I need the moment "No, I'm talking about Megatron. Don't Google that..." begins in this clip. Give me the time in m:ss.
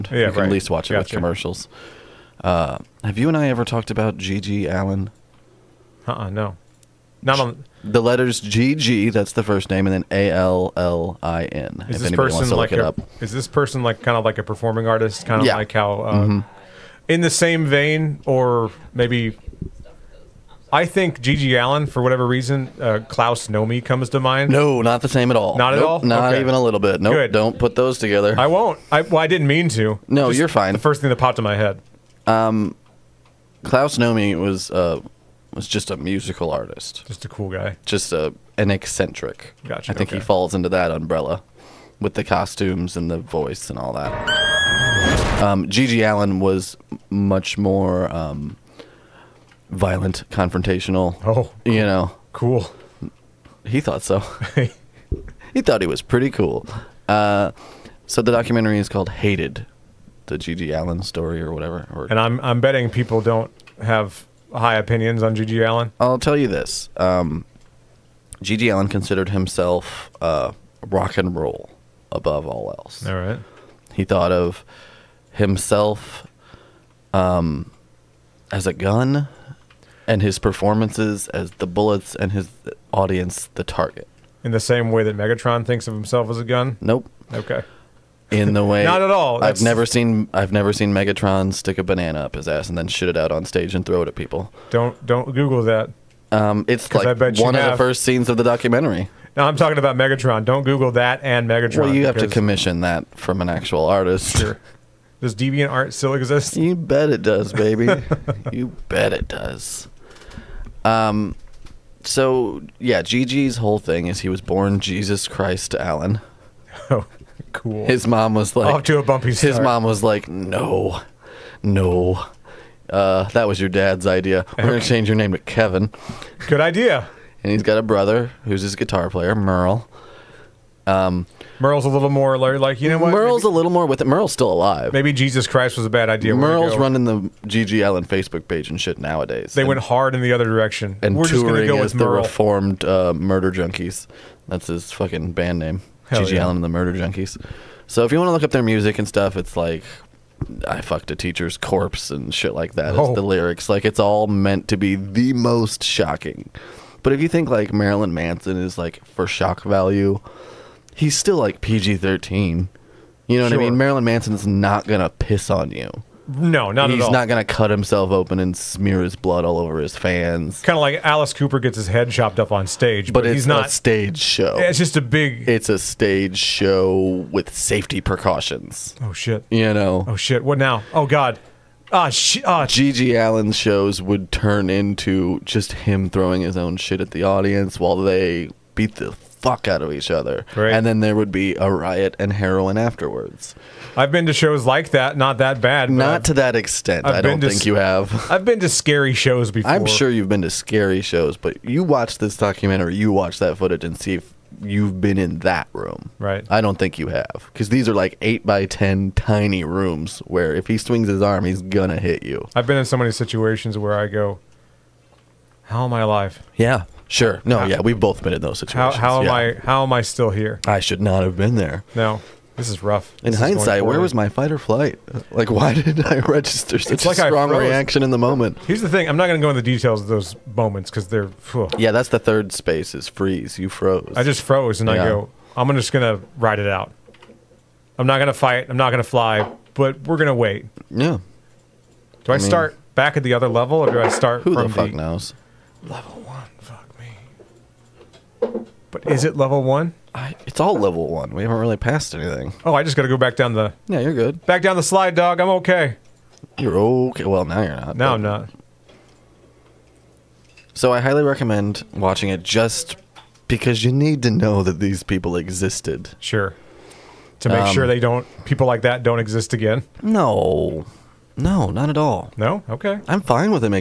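1:39.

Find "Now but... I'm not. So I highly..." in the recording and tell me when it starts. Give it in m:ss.
4:17.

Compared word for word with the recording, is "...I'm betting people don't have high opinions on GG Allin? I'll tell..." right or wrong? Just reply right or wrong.
right.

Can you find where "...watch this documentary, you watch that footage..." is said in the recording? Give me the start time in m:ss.
3:21.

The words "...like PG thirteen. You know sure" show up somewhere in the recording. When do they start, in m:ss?
2:41.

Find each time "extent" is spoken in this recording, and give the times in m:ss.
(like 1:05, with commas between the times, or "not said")
3:16.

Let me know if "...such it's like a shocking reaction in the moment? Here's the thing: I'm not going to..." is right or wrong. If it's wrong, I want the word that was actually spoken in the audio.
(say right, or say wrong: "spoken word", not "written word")
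wrong: "strong", not "shocking".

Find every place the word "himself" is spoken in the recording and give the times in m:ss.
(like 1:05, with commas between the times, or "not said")
1:09, 1:15, 1:25, 2:47.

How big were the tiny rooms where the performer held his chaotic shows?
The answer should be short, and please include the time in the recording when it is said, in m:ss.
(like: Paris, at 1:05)
8 by 10, at 3:28.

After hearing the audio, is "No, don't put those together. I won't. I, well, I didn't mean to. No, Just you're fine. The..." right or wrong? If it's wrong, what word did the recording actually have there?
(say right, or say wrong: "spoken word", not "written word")
right.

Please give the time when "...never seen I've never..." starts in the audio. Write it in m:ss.
1:29.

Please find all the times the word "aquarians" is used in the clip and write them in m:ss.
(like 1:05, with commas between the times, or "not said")
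not said.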